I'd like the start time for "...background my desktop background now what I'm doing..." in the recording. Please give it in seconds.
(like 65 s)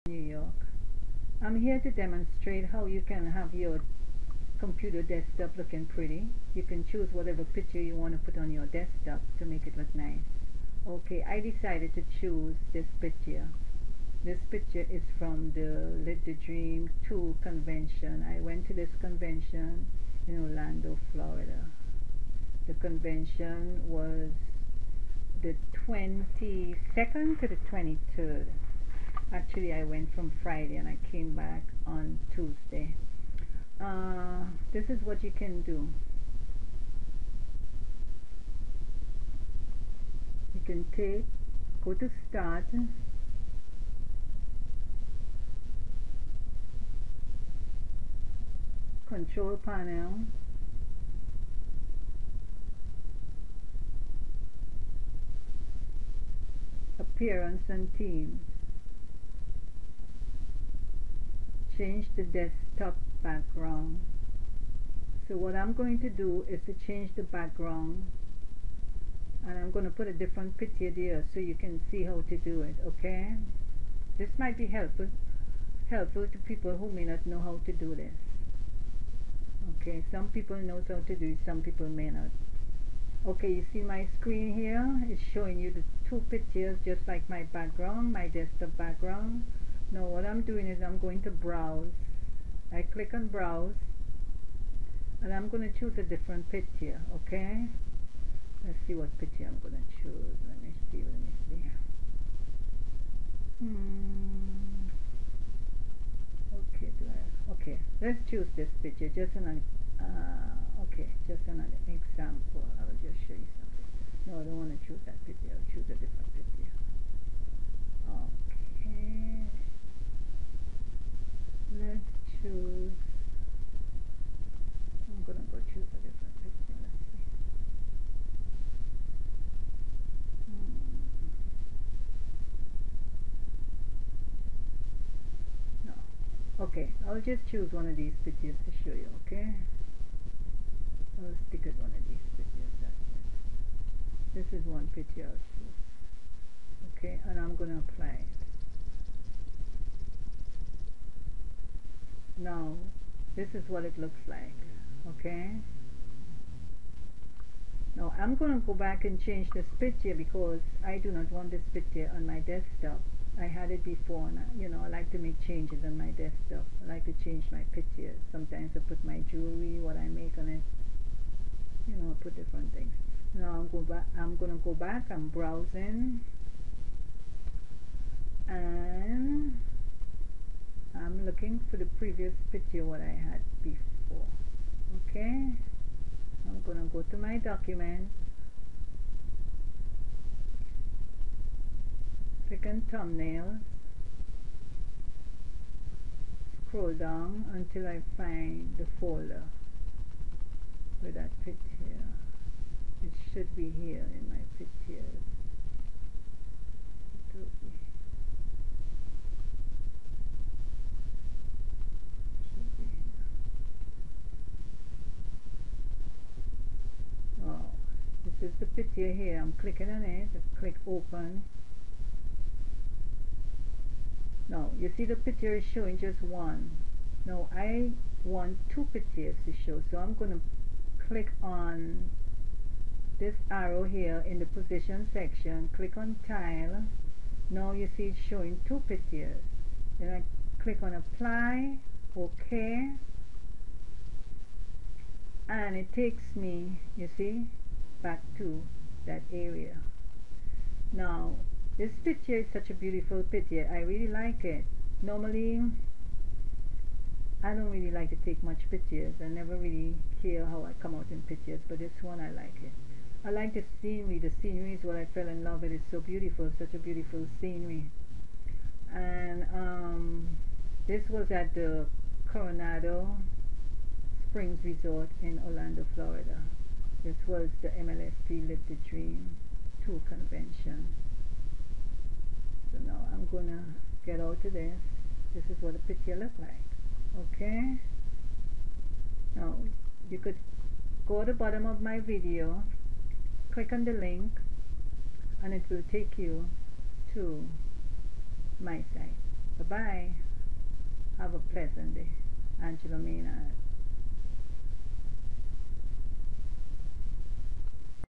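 87 s.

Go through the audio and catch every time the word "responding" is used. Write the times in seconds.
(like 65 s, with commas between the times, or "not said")
not said.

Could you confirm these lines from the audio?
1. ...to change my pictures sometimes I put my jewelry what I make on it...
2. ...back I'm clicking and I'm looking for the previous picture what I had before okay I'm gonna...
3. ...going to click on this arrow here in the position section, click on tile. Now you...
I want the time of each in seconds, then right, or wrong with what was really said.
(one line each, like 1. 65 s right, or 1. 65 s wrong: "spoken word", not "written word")
1. 167 s right
2. 174 s wrong: "browsing", not "clicking"
3. 230 s right.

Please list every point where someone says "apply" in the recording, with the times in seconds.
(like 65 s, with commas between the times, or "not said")
147 s, 240 s.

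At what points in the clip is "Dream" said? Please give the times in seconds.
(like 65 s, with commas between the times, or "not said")
16 s, 278 s.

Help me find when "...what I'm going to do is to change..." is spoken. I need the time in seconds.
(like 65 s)
65 s.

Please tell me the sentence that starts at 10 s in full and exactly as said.
Okay, I decided to choose this picture.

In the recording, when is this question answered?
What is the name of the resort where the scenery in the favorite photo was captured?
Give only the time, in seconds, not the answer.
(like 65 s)
272 s.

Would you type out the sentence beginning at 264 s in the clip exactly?
The scenery is what I fell in love with.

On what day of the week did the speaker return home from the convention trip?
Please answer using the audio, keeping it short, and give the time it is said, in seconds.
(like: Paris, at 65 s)
Tuesday, at 32 s.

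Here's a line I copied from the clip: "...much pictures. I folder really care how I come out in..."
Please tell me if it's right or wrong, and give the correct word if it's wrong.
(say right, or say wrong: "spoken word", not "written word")
wrong: "never", not "folder".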